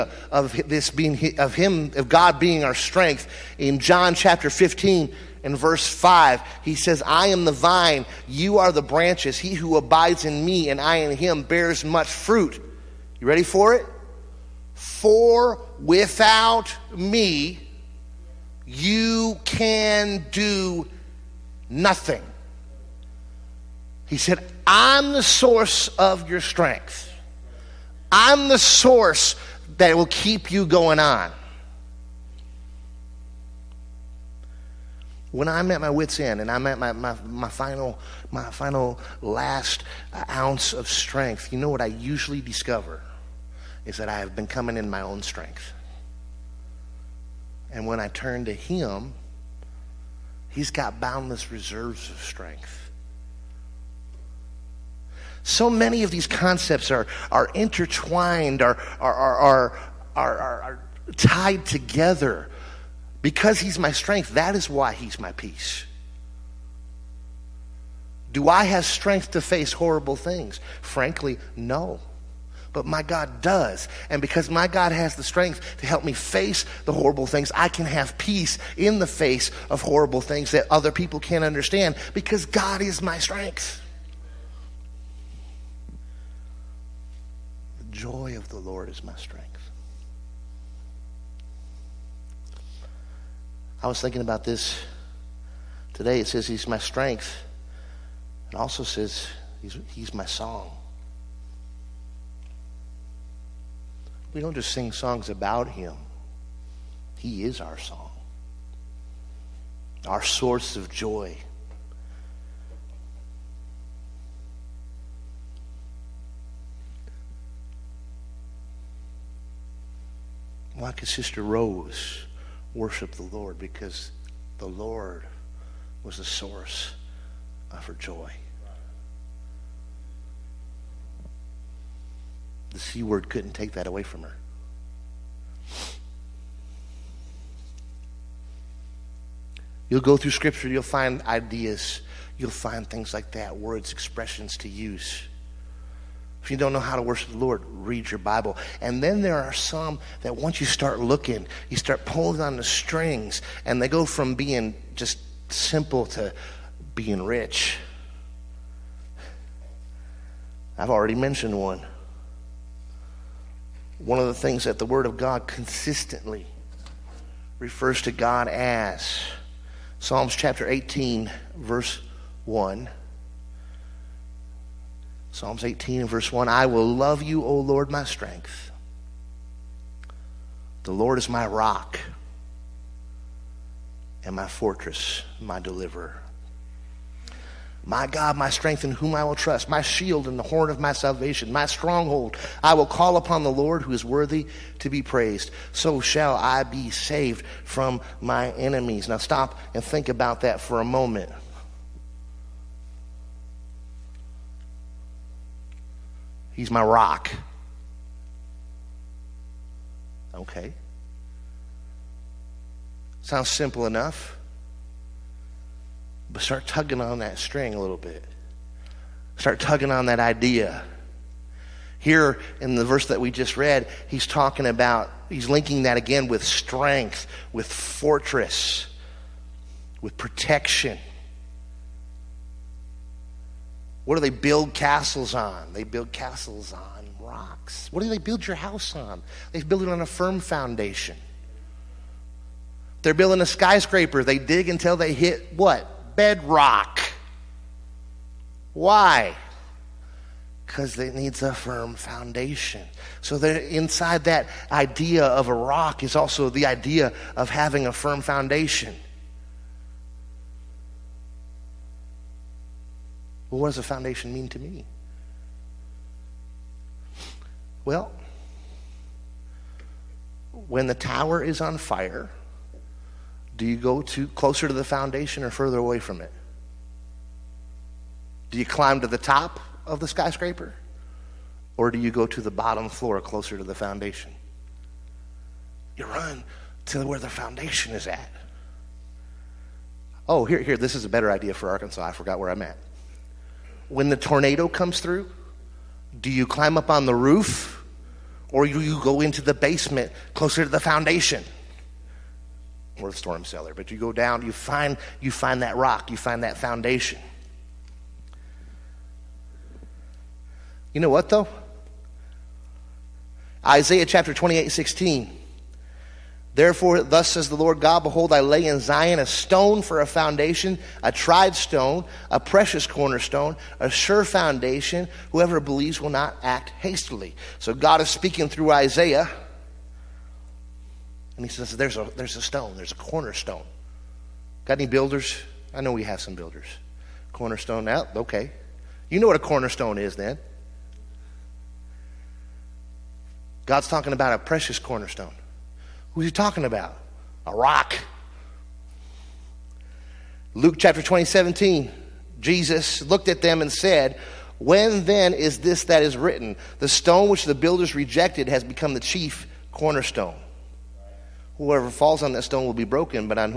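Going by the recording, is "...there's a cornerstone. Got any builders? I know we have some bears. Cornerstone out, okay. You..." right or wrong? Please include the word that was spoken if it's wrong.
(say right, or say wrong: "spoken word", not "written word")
wrong: "builders", not "bears".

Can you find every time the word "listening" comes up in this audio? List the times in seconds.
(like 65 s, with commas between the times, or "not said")
not said.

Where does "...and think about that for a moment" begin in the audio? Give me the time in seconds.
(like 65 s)
199 s.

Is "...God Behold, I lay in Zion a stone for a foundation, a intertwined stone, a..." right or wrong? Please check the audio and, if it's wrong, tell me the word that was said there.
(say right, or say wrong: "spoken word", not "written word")
wrong: "tried", not "intertwined".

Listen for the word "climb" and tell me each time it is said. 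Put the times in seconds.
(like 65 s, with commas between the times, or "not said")
278 s, 296 s.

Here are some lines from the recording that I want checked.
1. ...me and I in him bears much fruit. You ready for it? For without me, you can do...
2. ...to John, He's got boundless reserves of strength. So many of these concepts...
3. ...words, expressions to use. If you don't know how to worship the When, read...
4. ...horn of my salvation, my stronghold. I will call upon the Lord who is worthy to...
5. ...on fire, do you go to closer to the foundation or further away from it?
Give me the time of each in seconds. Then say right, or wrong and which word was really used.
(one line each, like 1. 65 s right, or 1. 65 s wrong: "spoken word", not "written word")
1. 10 s right
2. 48 s wrong: "Him", not "John"
3. 143 s wrong: "Lord", not "When"
4. 190 s right
5. 271 s right.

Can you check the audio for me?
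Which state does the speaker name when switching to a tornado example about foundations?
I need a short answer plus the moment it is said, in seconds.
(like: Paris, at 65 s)
Arkansas, at 291 s.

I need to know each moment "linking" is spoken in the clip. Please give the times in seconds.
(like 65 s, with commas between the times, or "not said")
225 s.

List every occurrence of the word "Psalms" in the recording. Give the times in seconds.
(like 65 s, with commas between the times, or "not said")
169 s, 175 s.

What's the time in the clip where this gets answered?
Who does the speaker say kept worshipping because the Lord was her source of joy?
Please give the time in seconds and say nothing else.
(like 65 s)
121 s.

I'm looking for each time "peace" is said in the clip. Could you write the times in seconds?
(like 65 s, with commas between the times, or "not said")
65 s, 78 s.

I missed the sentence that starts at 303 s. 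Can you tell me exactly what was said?
Or the storm cellar, but you go down, you find you find that rock, you find that foundation.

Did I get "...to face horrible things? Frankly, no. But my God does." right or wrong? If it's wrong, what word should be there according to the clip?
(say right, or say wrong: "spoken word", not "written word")
right.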